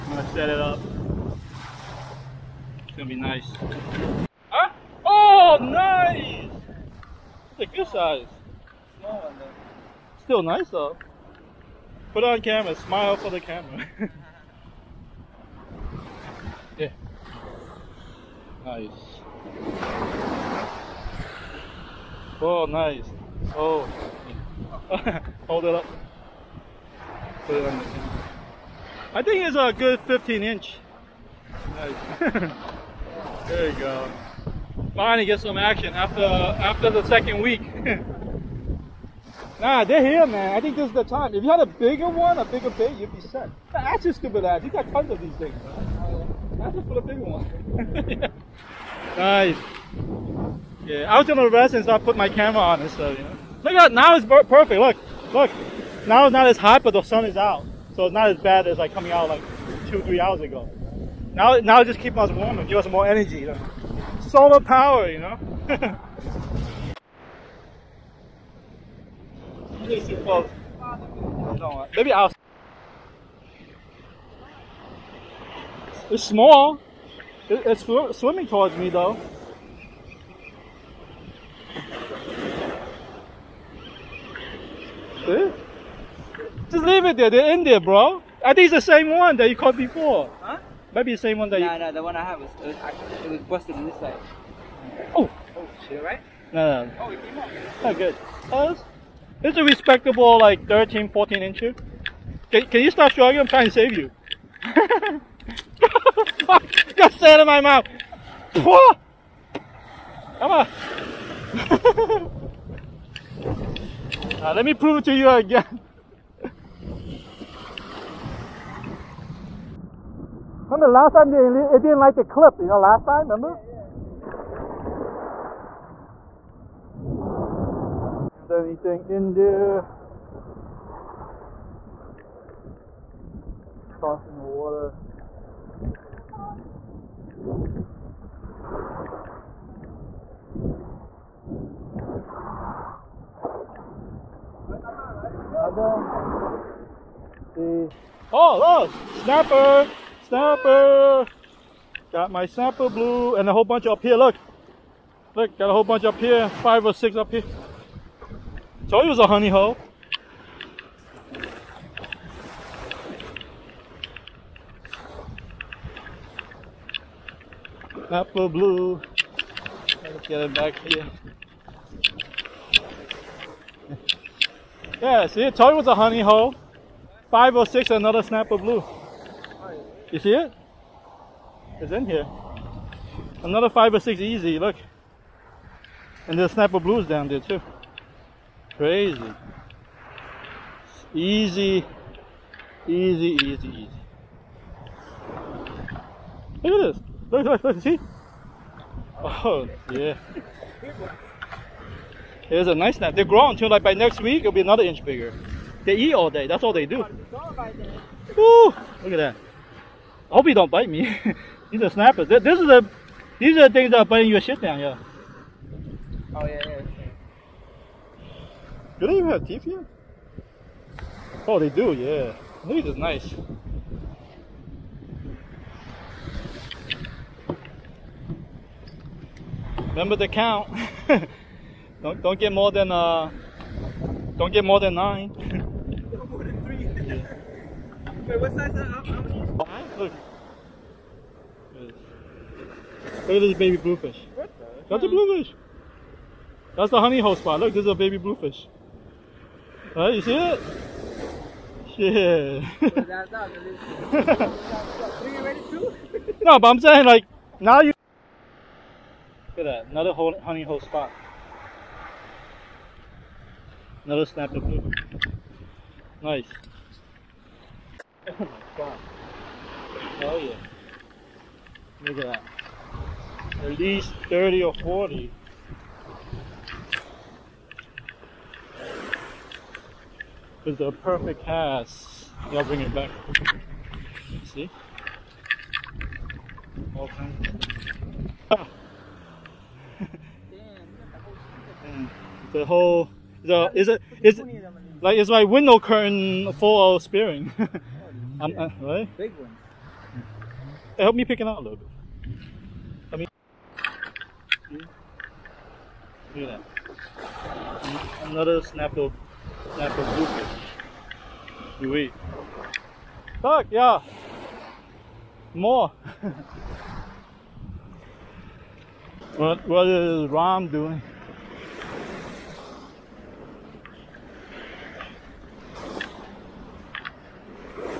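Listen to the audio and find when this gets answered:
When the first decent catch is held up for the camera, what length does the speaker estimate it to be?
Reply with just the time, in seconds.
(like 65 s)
30 s.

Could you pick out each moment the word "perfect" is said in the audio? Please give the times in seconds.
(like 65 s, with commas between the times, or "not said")
54 s, 280 s.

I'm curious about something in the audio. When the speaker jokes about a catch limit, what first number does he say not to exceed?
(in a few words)
9.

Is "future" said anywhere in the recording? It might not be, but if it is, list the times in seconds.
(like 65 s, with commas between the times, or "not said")
not said.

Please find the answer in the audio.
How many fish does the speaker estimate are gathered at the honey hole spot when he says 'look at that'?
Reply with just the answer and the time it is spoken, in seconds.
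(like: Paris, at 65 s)
30 or 40, at 274 s.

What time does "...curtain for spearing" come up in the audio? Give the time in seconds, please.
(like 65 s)
295 s.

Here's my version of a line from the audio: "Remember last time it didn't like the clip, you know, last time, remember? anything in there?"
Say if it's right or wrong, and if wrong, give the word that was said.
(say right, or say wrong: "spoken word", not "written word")
right.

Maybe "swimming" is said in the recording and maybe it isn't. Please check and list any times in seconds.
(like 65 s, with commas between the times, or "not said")
78 s.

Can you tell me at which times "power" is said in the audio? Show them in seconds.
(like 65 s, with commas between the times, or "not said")
64 s.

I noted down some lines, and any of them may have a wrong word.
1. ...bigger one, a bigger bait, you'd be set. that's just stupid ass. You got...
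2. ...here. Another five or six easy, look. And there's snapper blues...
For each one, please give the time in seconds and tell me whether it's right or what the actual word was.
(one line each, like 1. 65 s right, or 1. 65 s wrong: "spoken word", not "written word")
1. 41 s right
2. 182 s right.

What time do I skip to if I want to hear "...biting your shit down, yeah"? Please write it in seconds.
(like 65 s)
214 s.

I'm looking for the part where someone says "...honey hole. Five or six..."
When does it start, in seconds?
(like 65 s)
175 s.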